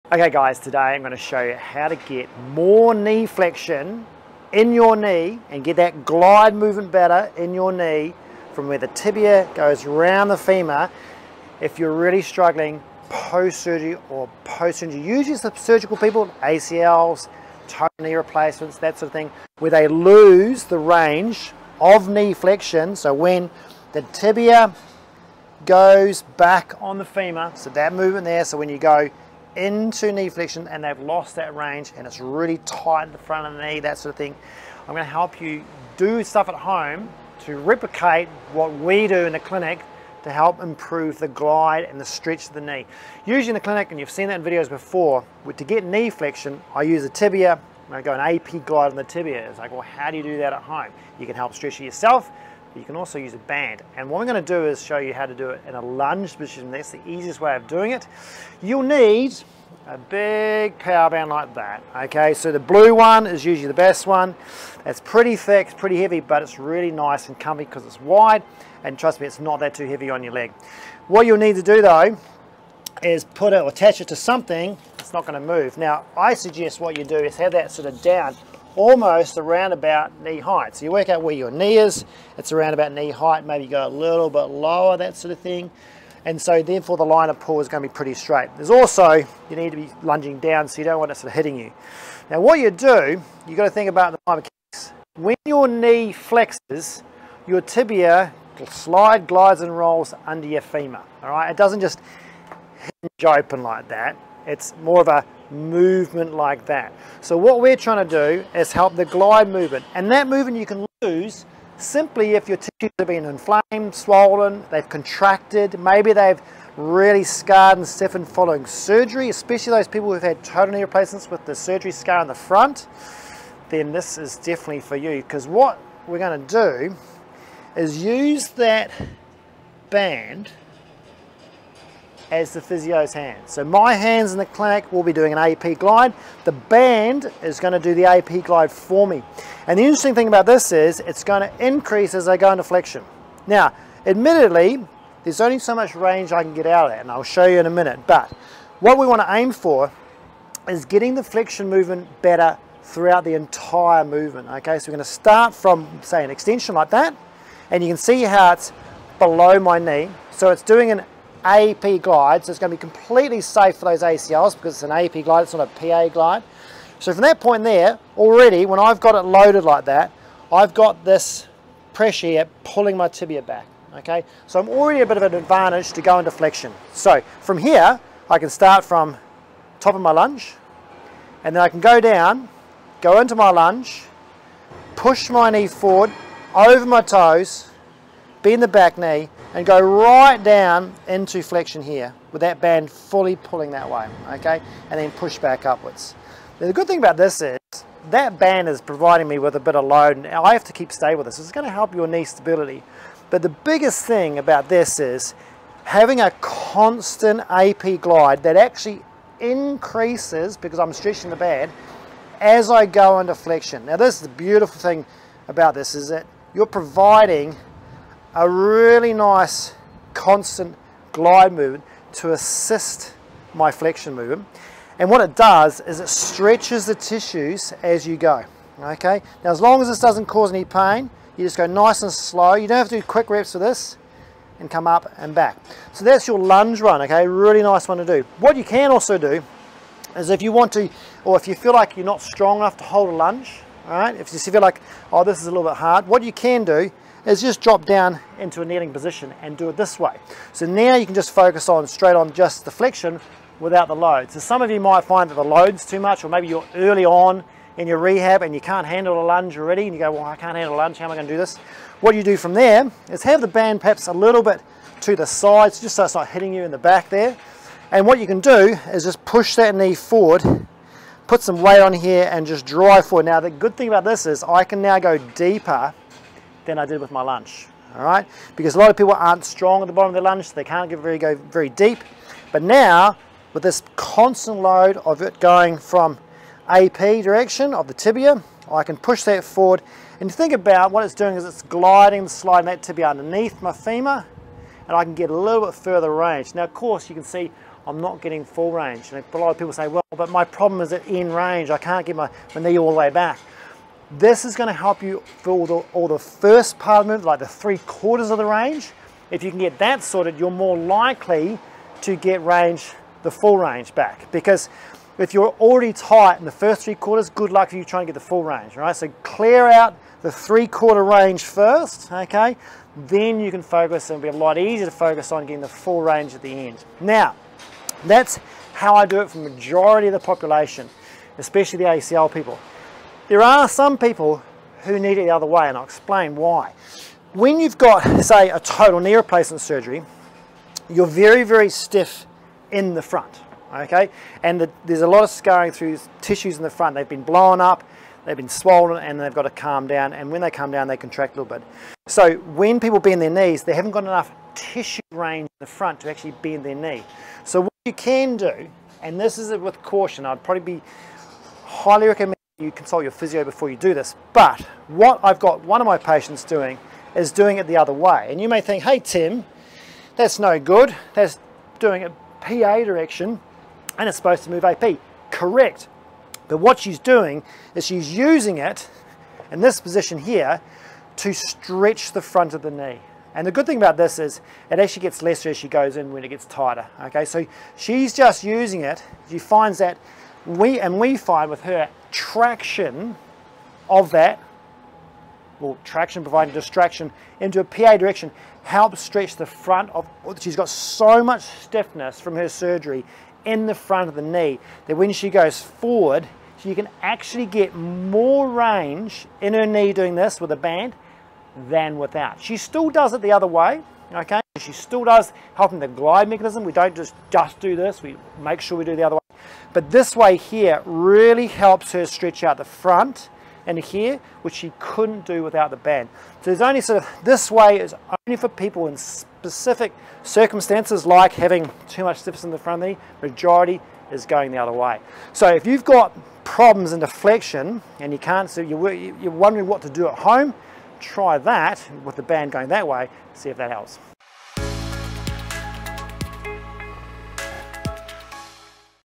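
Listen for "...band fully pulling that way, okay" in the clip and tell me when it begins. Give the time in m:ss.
3:12.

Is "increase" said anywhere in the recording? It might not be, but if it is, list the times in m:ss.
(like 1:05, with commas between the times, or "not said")
2:21, 3:29.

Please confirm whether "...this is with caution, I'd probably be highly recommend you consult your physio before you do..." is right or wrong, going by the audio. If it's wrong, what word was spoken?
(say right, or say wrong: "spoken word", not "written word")
right.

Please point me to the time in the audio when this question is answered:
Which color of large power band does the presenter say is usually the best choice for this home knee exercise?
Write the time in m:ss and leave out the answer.
1:02.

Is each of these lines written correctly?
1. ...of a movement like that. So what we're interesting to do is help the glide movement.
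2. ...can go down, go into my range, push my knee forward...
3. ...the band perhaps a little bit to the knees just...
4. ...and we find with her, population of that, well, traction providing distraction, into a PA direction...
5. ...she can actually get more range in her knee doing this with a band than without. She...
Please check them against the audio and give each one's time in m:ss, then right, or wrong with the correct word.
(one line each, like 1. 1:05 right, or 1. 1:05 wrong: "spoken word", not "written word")
1. 1:45 wrong: "trying", not "interesting"
2. 3:01 wrong: "lunge", not "range"
3. 4:23 wrong: "sides", not "knees"
4. 6:30 wrong: "traction", not "population"
5. 6:46 right.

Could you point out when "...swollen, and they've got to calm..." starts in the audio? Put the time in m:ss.
5:48.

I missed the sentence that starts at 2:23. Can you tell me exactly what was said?
Now, admittedly, there's only so much range I can get out of that, and I'll show you in a minute.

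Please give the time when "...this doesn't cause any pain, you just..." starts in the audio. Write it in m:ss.
3:49.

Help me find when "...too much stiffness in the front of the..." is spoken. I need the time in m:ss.
7:11.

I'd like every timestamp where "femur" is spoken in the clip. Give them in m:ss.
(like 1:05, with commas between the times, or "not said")
0:10, 0:27, 1:40, 4:53.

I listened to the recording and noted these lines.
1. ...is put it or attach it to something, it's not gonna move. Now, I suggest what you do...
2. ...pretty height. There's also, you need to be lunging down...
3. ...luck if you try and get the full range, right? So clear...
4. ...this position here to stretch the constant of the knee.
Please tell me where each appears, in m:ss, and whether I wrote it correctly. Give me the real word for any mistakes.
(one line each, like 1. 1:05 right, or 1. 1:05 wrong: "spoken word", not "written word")
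1. 1:13 right
2. 1:27 wrong: "straight", not "height"
3. 5:17 right
4. 6:19 wrong: "front", not "constant".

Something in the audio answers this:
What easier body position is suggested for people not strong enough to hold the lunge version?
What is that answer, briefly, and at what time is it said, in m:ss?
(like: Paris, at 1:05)
Kneeling position, at 4:08.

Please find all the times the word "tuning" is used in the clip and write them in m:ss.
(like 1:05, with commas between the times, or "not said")
not said.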